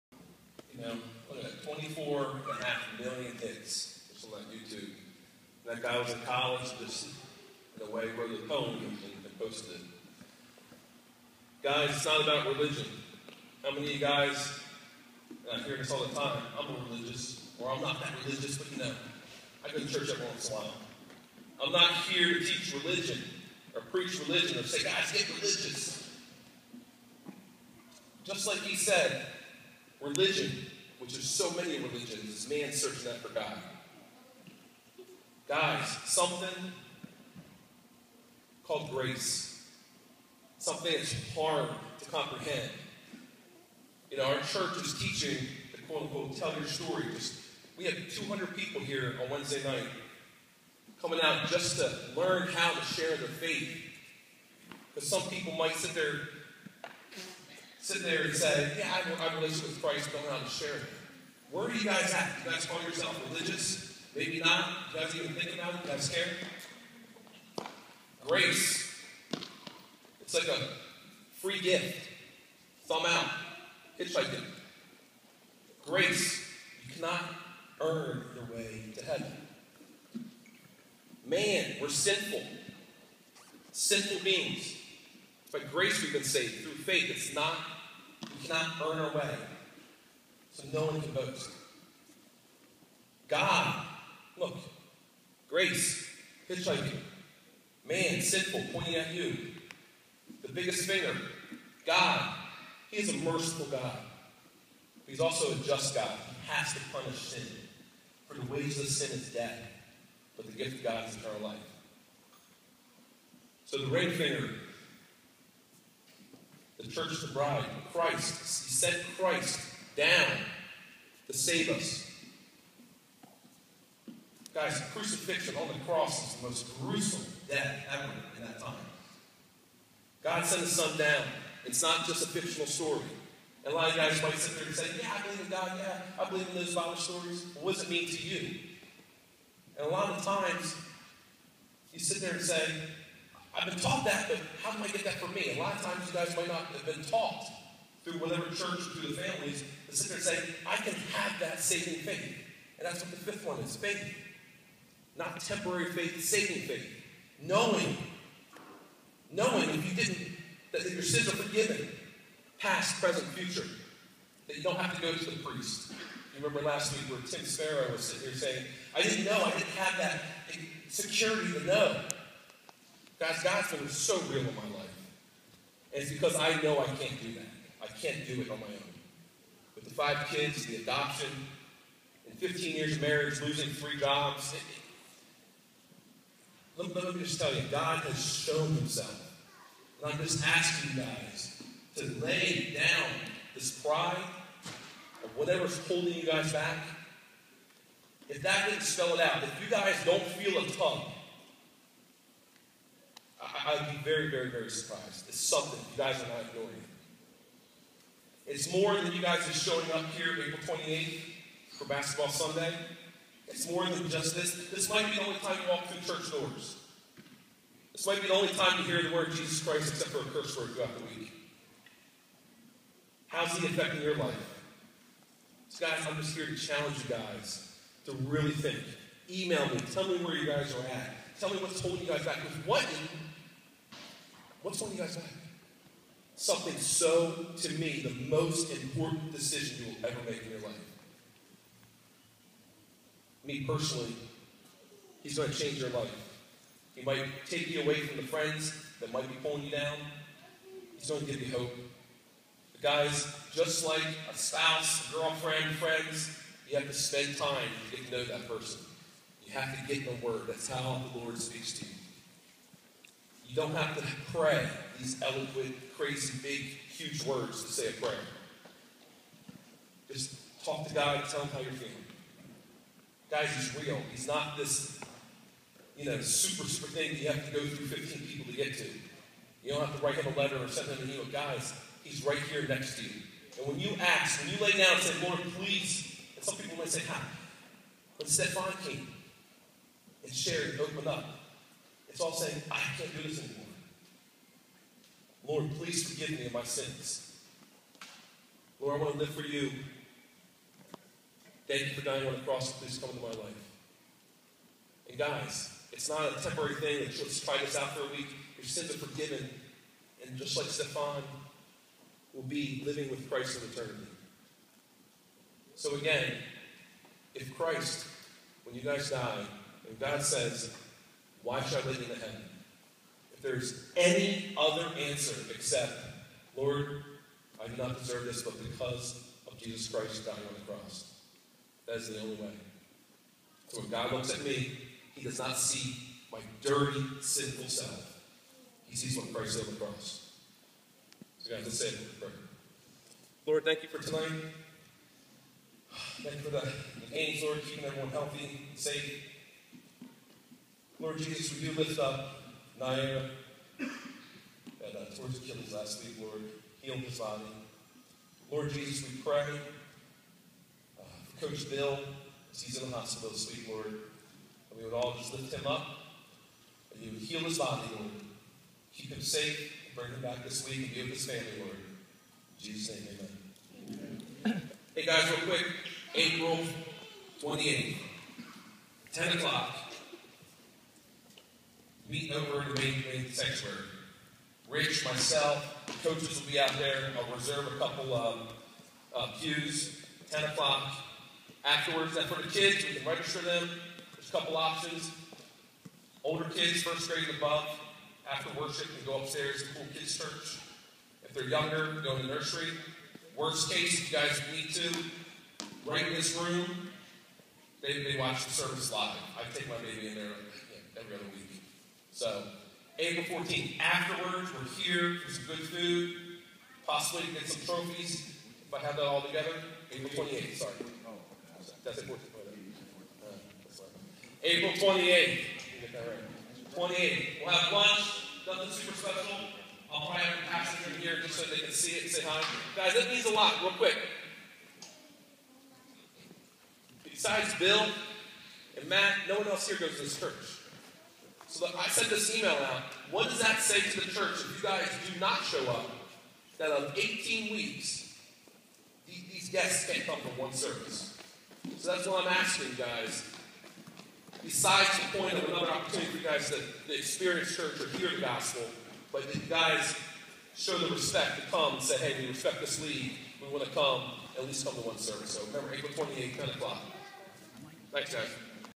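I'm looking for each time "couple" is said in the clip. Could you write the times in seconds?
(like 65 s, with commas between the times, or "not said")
387 s, 394 s.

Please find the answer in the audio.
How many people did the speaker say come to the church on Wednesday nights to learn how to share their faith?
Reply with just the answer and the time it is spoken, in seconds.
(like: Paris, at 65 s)
200, at 48 s.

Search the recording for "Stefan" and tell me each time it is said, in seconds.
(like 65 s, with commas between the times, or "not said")
288 s, 310 s.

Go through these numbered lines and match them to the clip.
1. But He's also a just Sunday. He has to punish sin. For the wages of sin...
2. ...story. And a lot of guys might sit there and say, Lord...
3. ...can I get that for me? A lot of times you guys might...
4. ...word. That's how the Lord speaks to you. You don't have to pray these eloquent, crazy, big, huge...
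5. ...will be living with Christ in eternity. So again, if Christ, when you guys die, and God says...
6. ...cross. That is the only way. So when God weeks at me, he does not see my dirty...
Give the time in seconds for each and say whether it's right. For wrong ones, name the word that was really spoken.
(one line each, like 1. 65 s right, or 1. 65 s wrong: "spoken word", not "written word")
1. 105 s wrong: "God", not "Sunday"
2. 132 s wrong: "Yeah", not "Lord"
3. 144 s right
4. 260 s right
5. 312 s right
6. 330 s wrong: "looks", not "weeks".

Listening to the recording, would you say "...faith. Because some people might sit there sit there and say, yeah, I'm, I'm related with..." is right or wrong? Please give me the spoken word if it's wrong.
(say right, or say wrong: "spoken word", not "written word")
right.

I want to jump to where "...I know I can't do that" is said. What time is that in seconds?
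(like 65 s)
176 s.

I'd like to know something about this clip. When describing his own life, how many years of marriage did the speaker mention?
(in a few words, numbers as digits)
15.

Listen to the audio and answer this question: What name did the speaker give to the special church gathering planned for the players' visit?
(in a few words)
Basketball Sunday.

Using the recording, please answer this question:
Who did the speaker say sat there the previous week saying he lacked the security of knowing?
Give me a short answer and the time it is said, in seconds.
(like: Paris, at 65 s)
Tim Sparrow, at 167 s.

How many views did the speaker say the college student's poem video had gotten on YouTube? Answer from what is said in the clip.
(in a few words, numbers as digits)
24 and a half million.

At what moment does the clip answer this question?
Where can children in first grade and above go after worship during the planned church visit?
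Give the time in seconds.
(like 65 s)
399 s.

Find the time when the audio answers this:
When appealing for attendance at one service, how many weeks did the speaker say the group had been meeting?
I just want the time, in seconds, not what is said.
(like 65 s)
446 s.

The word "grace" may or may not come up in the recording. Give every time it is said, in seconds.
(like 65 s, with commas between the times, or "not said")
38 s, 68 s, 75 s, 85 s, 95 s.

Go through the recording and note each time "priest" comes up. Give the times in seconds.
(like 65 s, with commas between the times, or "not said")
165 s.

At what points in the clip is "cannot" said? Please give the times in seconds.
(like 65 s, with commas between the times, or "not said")
76 s, 88 s.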